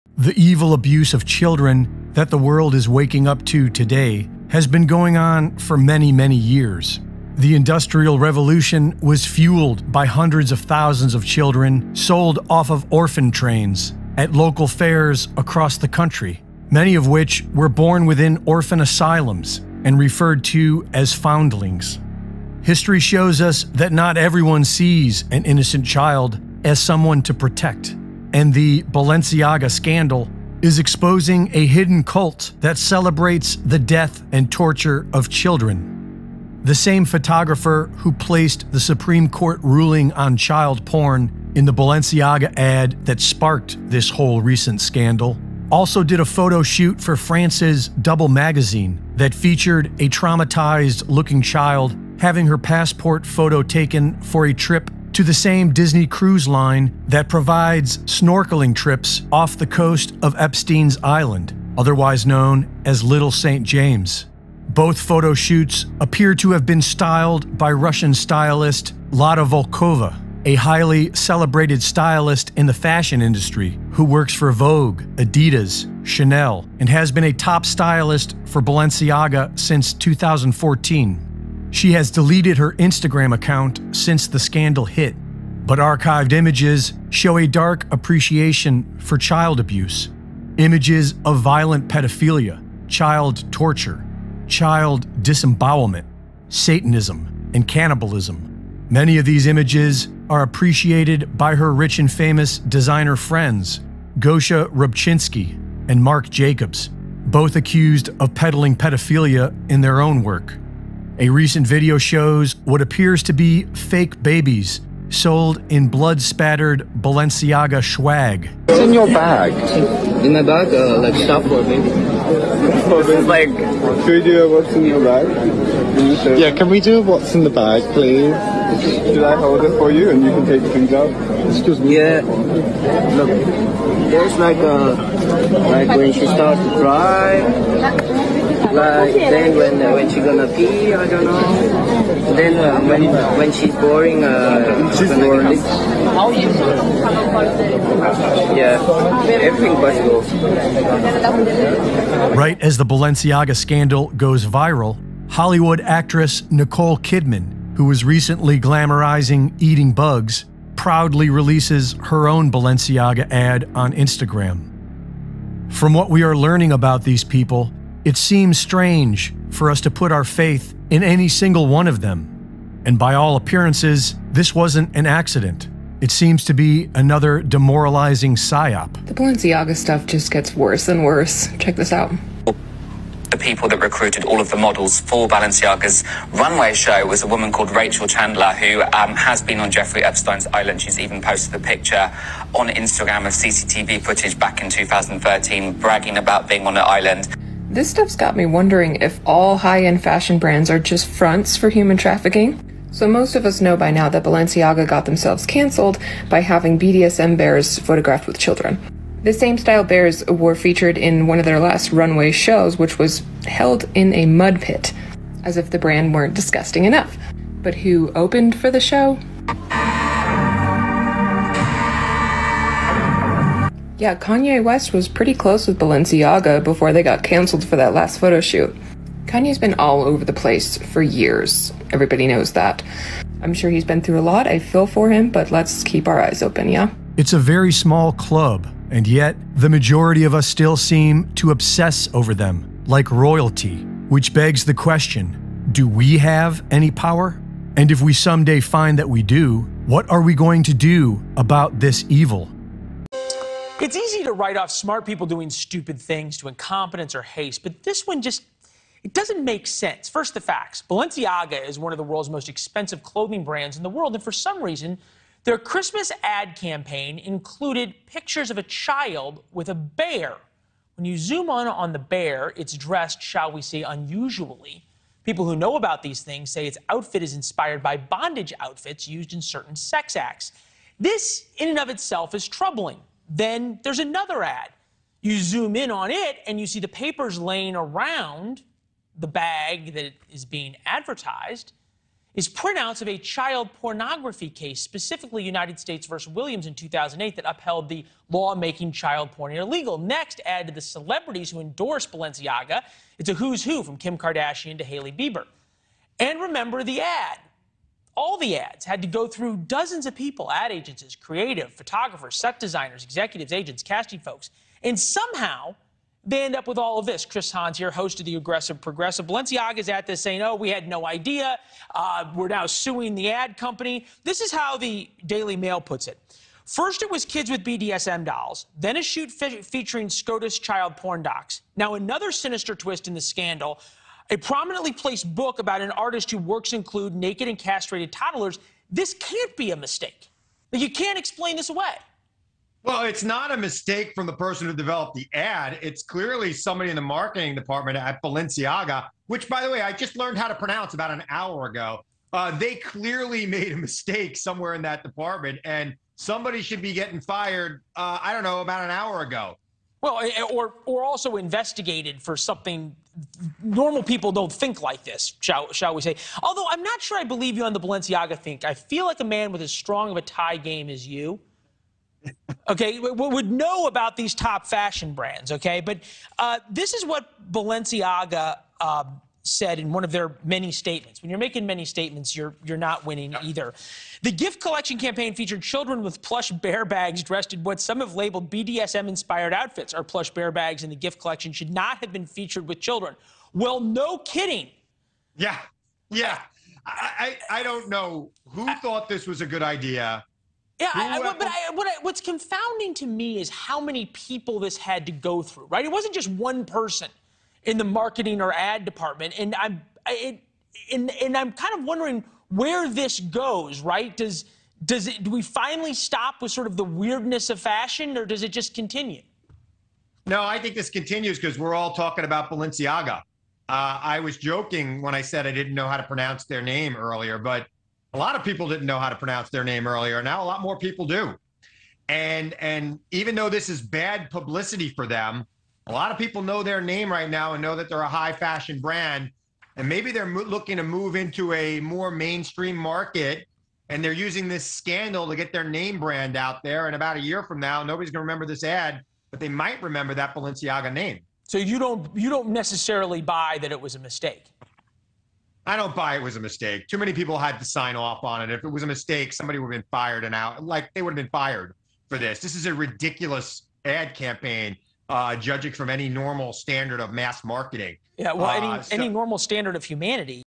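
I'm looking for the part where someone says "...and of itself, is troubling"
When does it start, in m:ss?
4:41.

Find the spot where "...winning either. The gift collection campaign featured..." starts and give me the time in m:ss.
6:23.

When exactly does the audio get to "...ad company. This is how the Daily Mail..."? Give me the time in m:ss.
5:23.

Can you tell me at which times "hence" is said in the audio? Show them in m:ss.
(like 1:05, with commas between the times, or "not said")
not said.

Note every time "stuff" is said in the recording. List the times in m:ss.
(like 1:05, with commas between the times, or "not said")
2:01, 2:59, 3:17.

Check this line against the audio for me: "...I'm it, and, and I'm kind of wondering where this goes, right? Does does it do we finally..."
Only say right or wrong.
right.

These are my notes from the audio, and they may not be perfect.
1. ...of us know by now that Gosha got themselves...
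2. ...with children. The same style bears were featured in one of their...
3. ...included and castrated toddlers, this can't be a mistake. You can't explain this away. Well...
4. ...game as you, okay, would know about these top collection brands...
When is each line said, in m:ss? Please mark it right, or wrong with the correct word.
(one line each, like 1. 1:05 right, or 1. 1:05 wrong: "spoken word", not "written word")
1. 3:23 wrong: "Balenciaga", not "Gosha"
2. 3:28 right
3. 5:37 wrong: "naked", not "included"
4. 6:10 wrong: "fashion", not "collection".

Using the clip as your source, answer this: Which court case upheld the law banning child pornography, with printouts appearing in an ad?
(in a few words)
United States versus Williams.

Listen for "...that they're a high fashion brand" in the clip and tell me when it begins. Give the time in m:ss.
7:17.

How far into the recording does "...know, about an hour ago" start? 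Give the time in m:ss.
5:58.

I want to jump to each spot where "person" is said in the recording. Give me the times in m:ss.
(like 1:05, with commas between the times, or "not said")
5:44, 6:46.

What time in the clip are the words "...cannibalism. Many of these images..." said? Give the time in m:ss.
1:37.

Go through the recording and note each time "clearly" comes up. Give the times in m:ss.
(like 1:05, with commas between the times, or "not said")
5:46, 5:52.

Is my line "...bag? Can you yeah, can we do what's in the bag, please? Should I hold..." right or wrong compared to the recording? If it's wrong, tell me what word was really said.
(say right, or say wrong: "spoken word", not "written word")
right.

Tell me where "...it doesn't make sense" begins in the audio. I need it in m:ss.
4:19.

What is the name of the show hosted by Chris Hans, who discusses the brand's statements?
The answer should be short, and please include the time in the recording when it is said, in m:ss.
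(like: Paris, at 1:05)
The Aggressive Progressive, at 5:18.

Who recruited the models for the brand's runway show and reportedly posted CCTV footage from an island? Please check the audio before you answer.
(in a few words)
Rachel Chandler.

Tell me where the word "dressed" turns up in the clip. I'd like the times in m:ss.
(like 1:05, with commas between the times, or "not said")
4:32, 6:27.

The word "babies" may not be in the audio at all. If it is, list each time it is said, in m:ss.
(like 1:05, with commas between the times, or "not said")
1:54.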